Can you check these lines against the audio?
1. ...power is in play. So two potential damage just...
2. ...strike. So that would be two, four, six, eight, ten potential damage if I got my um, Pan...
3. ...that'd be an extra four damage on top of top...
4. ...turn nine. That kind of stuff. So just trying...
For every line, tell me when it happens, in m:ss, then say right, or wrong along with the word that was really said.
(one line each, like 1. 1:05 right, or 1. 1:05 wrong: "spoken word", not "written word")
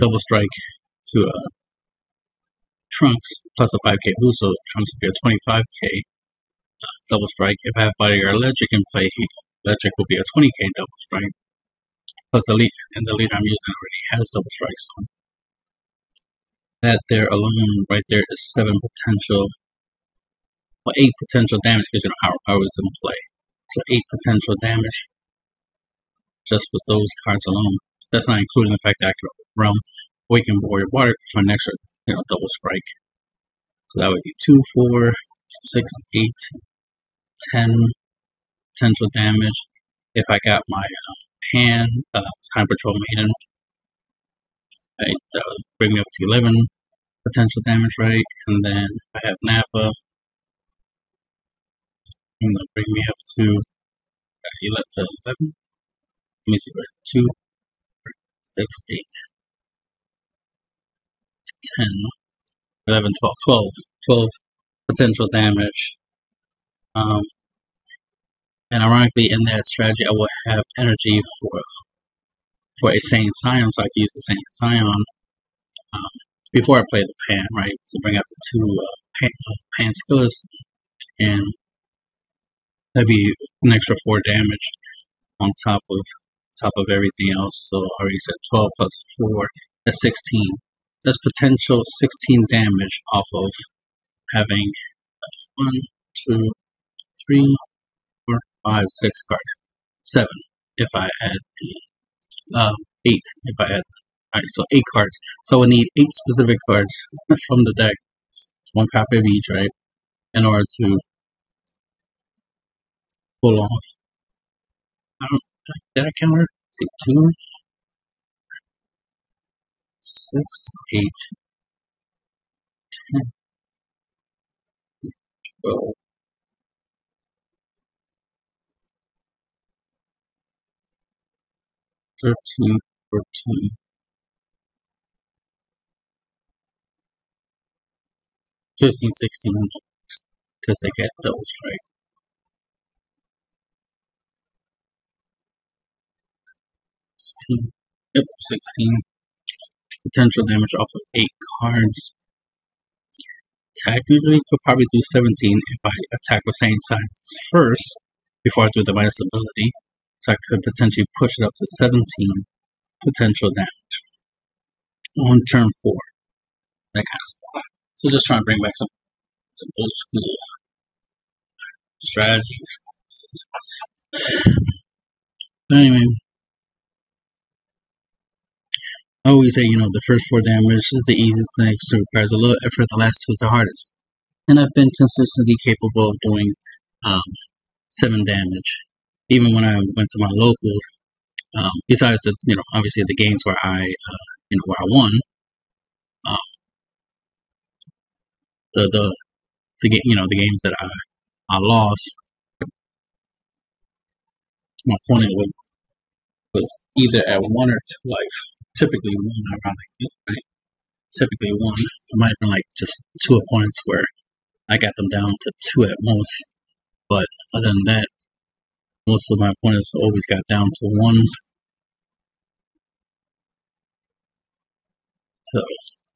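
1. 0:22 wrong: "eight", not "two"
2. 0:32 right
3. 1:22 right
4. 2:45 wrong: "four", not "nine".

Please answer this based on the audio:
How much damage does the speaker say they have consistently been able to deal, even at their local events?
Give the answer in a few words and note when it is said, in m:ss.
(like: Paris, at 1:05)
7, at 3:07.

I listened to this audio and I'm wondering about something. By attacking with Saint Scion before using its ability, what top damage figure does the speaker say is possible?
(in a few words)
17.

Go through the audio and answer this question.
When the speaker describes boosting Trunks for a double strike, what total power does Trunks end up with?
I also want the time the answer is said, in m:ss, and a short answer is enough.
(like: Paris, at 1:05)
25k, at 0:05.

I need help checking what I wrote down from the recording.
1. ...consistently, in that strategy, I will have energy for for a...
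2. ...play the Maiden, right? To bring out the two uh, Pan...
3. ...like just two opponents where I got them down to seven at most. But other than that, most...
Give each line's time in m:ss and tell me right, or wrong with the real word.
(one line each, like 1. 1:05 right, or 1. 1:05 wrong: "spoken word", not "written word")
1. 1:08 wrong: "ironically", not "consistently"
2. 1:16 wrong: "Pan", not "Maiden"
3. 3:32 wrong: "two", not "seven".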